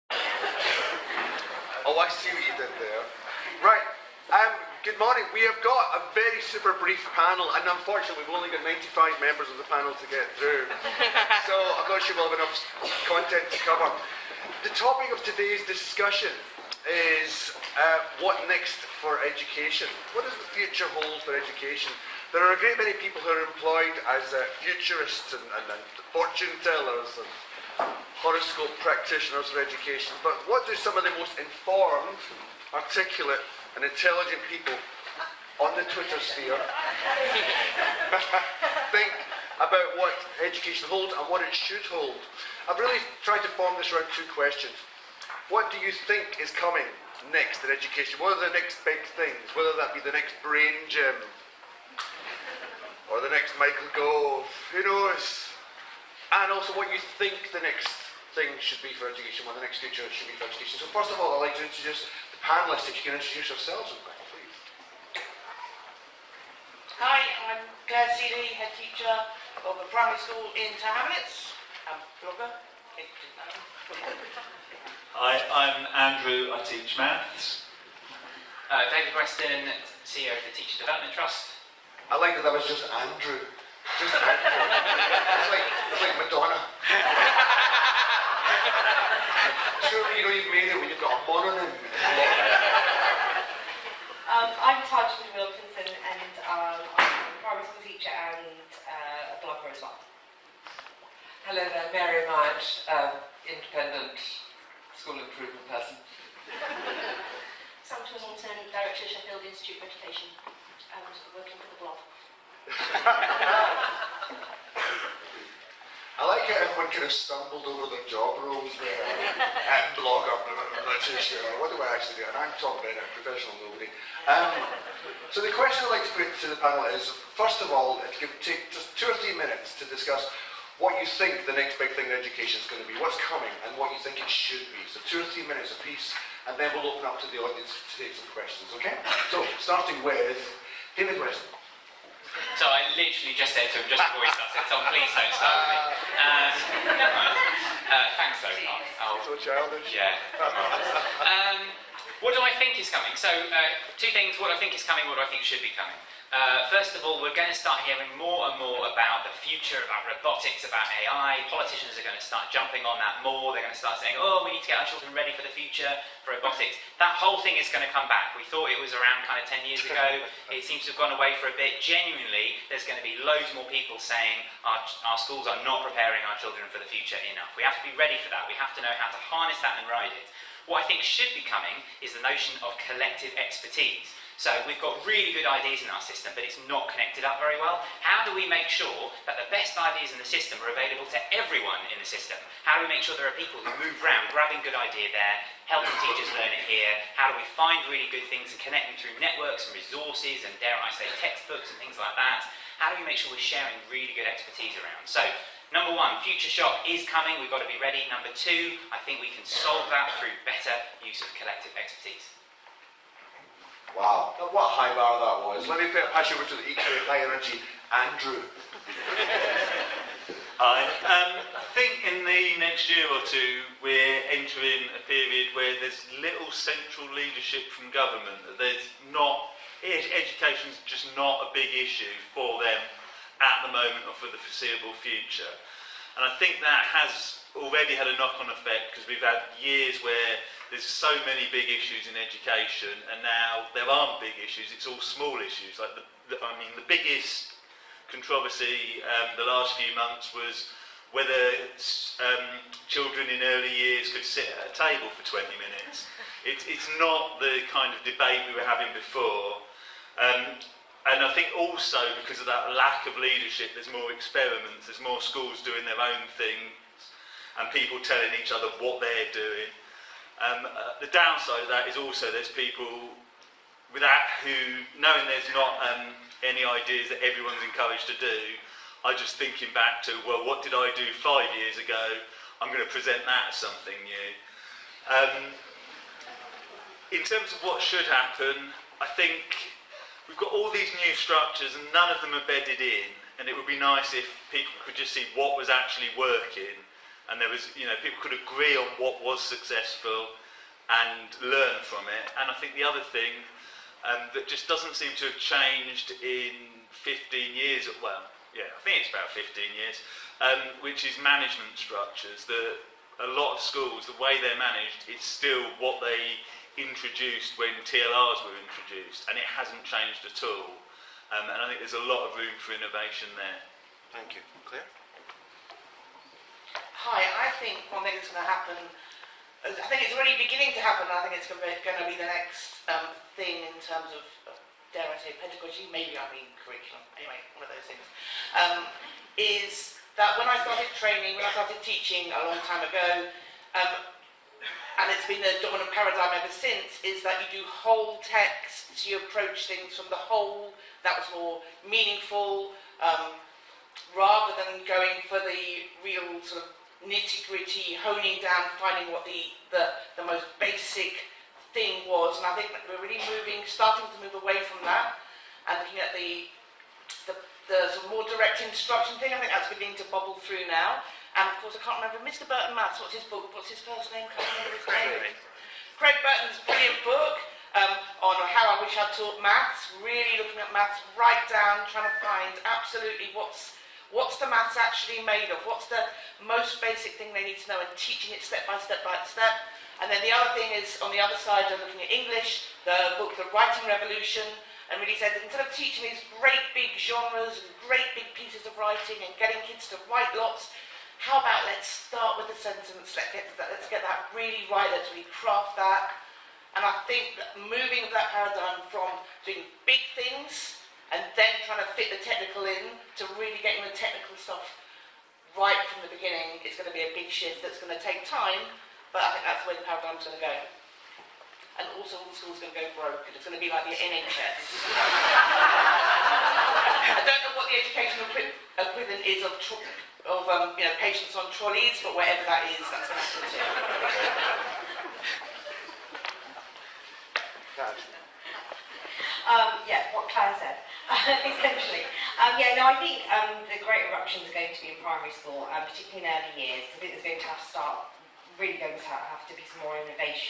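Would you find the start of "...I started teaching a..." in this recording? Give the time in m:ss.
5:41.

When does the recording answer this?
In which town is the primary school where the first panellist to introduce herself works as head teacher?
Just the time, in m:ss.
1:10.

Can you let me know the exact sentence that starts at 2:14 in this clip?
So two or three minutes apiece, and then we'll open up to the audience to take some questions, okay?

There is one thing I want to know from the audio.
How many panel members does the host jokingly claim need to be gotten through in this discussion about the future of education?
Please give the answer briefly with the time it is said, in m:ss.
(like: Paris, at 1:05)
95, at 0:08.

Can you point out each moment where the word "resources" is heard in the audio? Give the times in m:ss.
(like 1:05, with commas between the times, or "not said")
3:19.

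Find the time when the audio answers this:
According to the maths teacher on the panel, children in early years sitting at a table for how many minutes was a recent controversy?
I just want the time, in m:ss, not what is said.
4:15.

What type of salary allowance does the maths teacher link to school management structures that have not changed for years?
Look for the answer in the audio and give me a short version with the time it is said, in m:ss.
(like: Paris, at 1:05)
TLRs, at 5:17.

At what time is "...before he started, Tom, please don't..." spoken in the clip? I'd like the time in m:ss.
2:24.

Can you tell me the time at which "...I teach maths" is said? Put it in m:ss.
1:16.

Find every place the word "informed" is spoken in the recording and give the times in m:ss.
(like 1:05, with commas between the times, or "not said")
0:31.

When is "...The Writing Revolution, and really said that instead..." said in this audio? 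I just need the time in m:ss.
6:33.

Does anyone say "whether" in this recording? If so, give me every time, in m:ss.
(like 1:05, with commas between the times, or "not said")
0:49, 4:11.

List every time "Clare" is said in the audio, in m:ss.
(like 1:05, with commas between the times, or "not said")
1:07, 5:24, 7:20.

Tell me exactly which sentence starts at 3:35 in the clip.
Let me pass you over to the equally high energy Andrew.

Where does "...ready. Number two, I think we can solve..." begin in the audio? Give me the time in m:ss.
3:27.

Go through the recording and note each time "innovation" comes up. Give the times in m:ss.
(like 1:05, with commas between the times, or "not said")
5:22, 7:29.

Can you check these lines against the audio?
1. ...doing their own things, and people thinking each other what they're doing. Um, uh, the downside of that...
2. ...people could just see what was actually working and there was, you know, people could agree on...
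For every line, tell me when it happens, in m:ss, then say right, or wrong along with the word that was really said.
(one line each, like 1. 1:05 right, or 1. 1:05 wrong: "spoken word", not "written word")
1. 4:25 wrong: "telling", not "thinking"
2. 4:54 right.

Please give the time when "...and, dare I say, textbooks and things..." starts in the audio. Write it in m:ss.
3:20.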